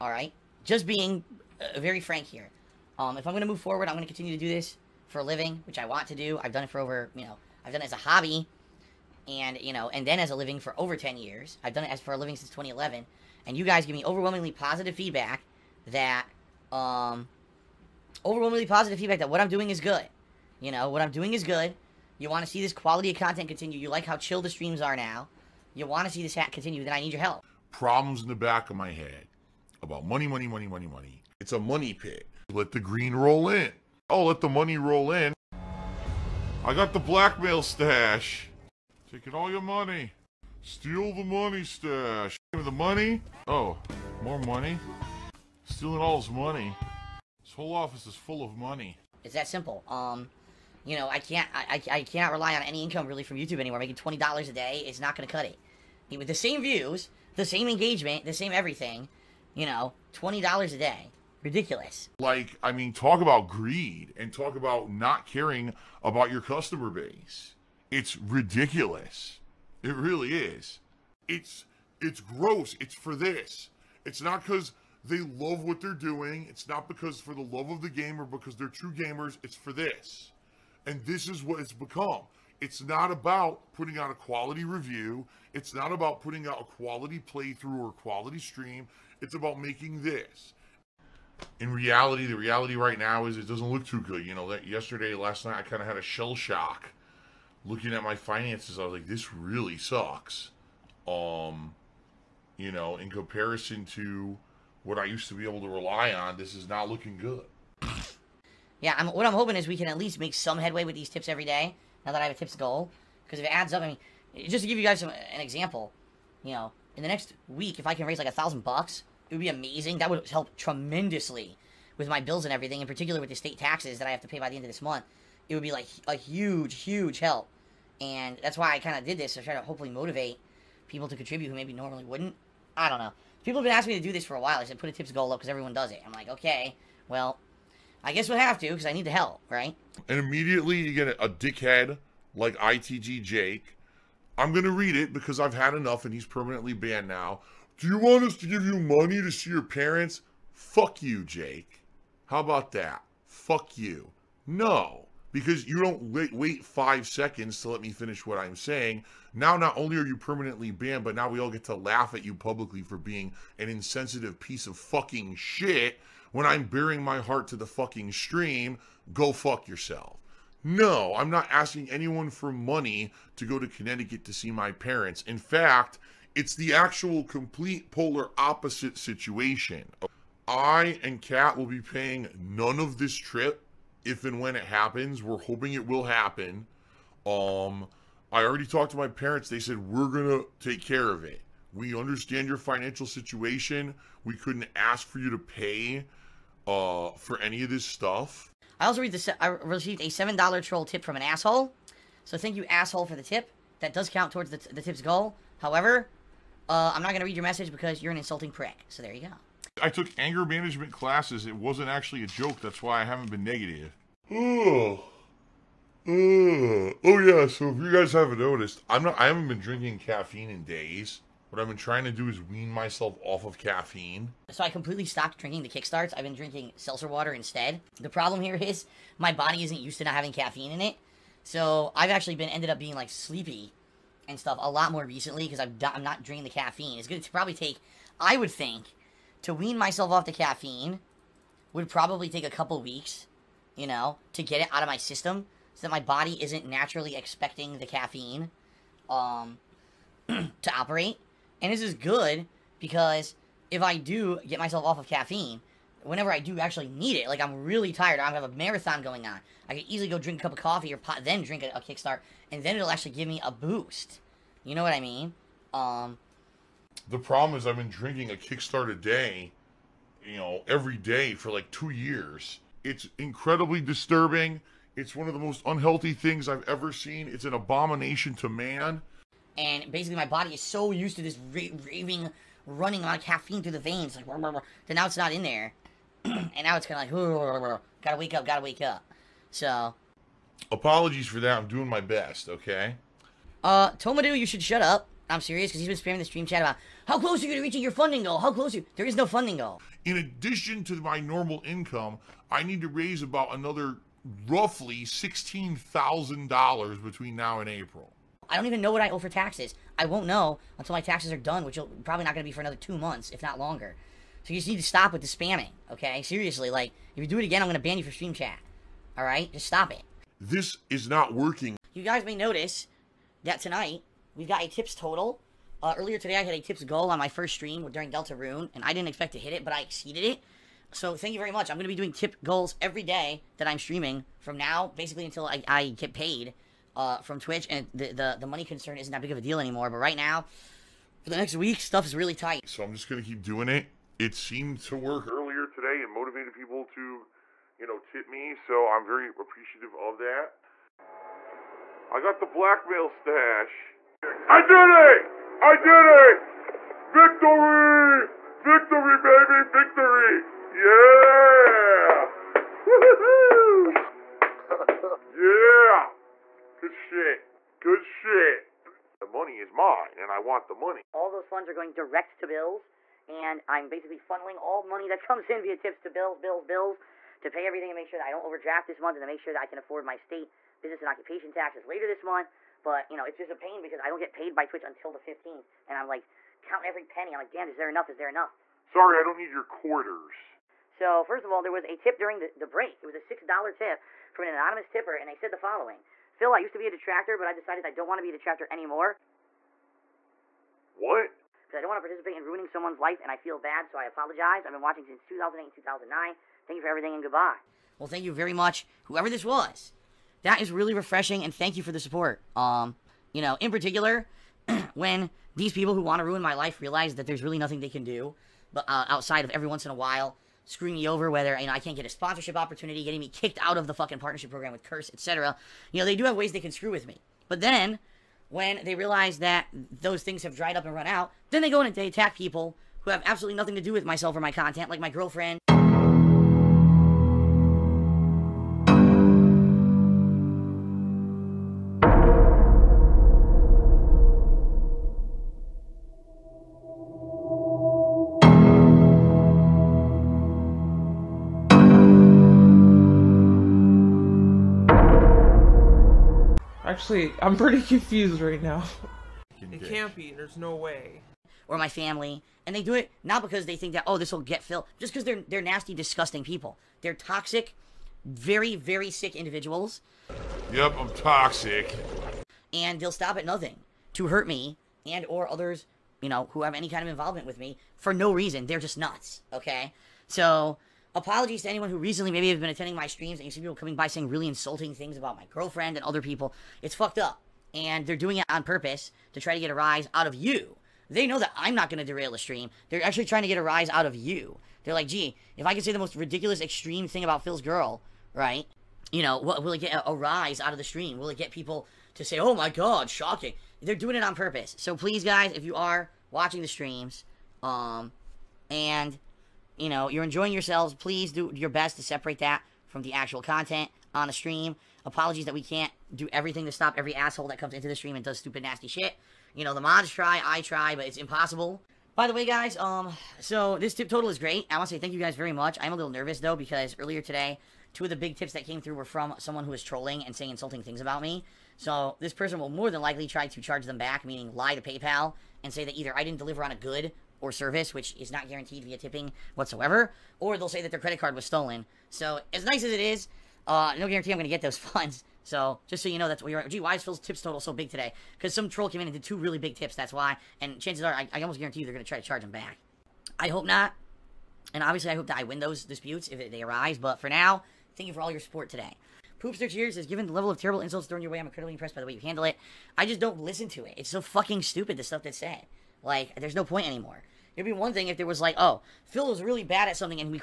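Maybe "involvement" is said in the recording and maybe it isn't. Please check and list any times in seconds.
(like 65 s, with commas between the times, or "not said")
477 s.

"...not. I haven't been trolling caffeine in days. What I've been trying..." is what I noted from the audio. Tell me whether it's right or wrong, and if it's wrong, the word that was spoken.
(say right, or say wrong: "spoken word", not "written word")
wrong: "drinking", not "trolling".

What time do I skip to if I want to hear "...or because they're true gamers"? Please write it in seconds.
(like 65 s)
78 s.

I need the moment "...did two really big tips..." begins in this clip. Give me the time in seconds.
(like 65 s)
549 s.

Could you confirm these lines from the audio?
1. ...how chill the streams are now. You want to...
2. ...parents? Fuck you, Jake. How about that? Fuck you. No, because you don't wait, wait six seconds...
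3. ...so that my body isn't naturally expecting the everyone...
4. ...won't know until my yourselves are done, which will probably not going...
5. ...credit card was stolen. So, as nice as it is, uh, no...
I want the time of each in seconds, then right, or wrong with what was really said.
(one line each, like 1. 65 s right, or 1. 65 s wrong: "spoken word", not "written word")
1. 24 s right
2. 149 s wrong: "five", not "six"
3. 245 s wrong: "caffeine", not "everyone"
4. 310 s wrong: "taxes", not "yourselves"
5. 540 s right.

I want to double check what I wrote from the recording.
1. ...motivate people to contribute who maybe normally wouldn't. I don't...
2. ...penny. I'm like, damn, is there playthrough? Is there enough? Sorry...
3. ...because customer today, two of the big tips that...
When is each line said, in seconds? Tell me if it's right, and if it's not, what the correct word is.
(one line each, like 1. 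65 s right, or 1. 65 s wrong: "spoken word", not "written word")
1. 129 s right
2. 387 s wrong: "enough", not "playthrough"
3. 526 s wrong: "earlier", not "customer".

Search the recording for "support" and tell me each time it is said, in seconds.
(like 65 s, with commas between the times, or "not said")
411 s, 558 s.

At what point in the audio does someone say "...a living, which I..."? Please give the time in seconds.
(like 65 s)
5 s.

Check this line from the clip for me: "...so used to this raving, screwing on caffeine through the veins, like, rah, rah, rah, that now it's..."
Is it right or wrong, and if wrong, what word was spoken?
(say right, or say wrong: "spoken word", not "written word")
wrong: "running", not "screwing".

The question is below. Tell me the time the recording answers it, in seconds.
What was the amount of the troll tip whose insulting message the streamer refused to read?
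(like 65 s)
200 s.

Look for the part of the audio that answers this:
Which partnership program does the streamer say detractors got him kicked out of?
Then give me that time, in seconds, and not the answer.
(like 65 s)
424 s.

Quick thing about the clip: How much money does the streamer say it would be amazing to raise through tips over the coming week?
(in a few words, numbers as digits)
$1,000.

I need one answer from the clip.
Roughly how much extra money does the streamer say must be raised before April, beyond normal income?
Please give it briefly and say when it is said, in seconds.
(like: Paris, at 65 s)
$16,000, at 305 s.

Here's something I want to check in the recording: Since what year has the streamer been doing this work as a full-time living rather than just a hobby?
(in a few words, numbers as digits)
2011.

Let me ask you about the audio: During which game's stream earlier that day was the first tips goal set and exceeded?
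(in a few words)
Deltarune.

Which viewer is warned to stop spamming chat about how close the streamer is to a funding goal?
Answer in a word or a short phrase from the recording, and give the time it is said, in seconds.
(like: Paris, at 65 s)
Tomadu, at 293 s.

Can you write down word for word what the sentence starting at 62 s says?
Like, I mean, talk about greed and talk about not caring about your customer base.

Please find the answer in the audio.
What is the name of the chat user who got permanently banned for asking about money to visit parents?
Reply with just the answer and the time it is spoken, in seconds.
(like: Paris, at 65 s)
ITG Jake, at 142 s.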